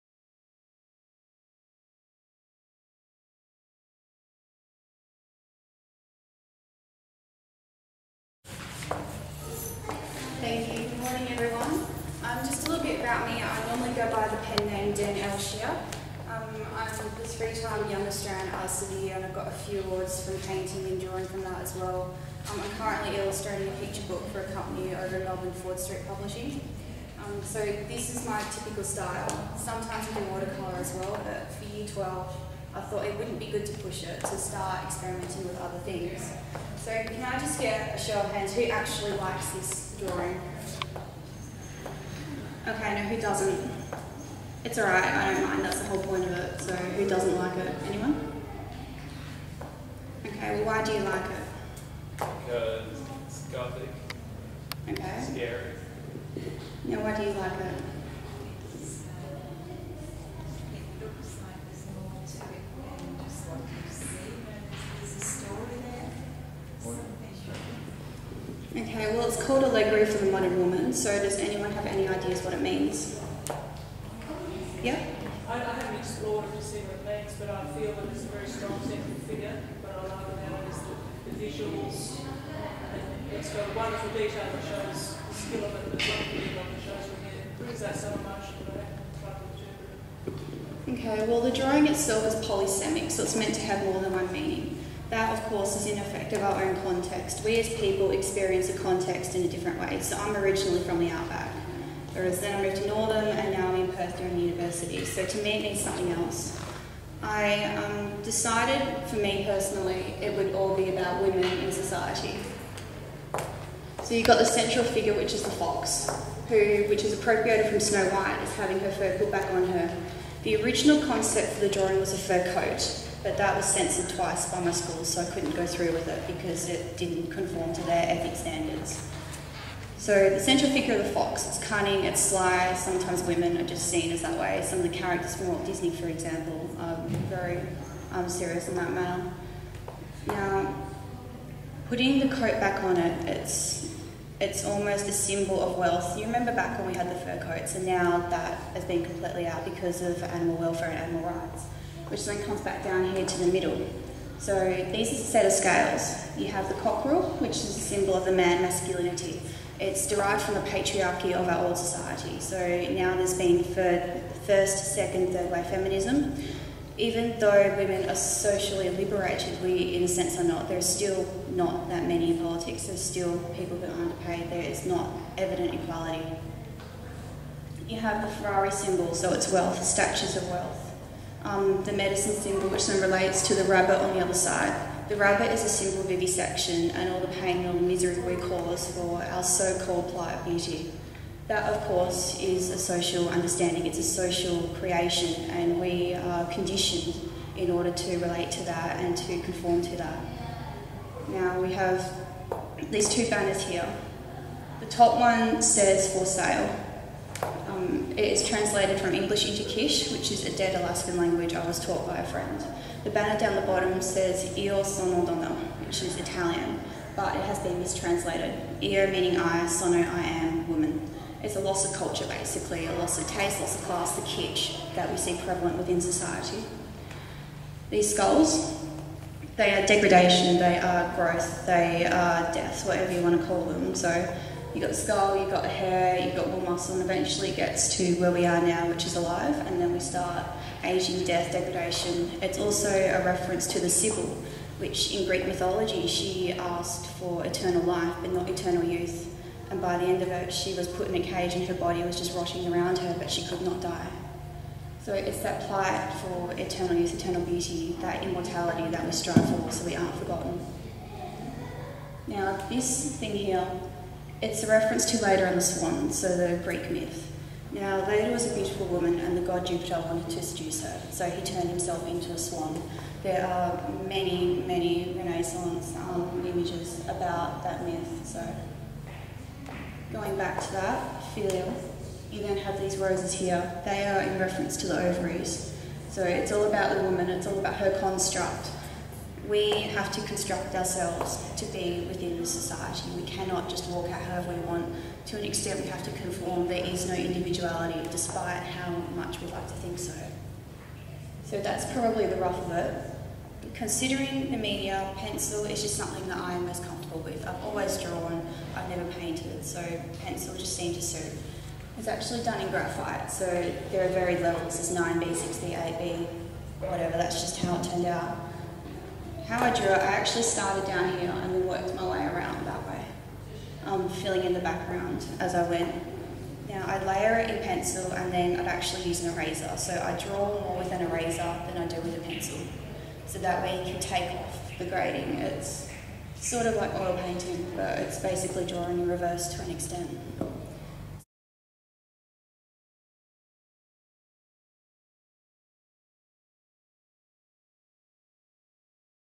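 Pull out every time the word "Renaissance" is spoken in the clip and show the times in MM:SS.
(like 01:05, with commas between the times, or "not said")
04:35.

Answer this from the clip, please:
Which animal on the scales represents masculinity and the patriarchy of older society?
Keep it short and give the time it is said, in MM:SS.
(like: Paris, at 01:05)
The cockerel, at 02:36.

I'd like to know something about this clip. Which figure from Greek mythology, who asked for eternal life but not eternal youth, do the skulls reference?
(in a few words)
The Sibyl.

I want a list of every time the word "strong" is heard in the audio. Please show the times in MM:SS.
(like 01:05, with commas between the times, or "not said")
01:18.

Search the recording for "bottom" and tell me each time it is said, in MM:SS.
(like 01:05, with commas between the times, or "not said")
03:33.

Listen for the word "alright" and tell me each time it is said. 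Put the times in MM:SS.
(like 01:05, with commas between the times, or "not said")
00:44.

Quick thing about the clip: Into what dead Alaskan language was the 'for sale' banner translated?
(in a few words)
Kish.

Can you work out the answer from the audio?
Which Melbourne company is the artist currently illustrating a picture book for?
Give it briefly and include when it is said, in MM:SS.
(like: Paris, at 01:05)
Ford Street Publishing, at 00:25.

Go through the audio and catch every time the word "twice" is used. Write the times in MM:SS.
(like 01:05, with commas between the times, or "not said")
02:04.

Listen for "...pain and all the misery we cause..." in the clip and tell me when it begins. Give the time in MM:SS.
03:07.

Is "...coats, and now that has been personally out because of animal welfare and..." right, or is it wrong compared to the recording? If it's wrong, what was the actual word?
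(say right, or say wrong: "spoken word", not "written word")
wrong: "completely", not "personally".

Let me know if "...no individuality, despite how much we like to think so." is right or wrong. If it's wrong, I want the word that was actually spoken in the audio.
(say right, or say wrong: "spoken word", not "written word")
right.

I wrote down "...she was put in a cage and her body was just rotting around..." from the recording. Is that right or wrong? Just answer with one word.
right.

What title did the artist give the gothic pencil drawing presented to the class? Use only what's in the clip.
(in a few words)
Allegory for the Modern Woman.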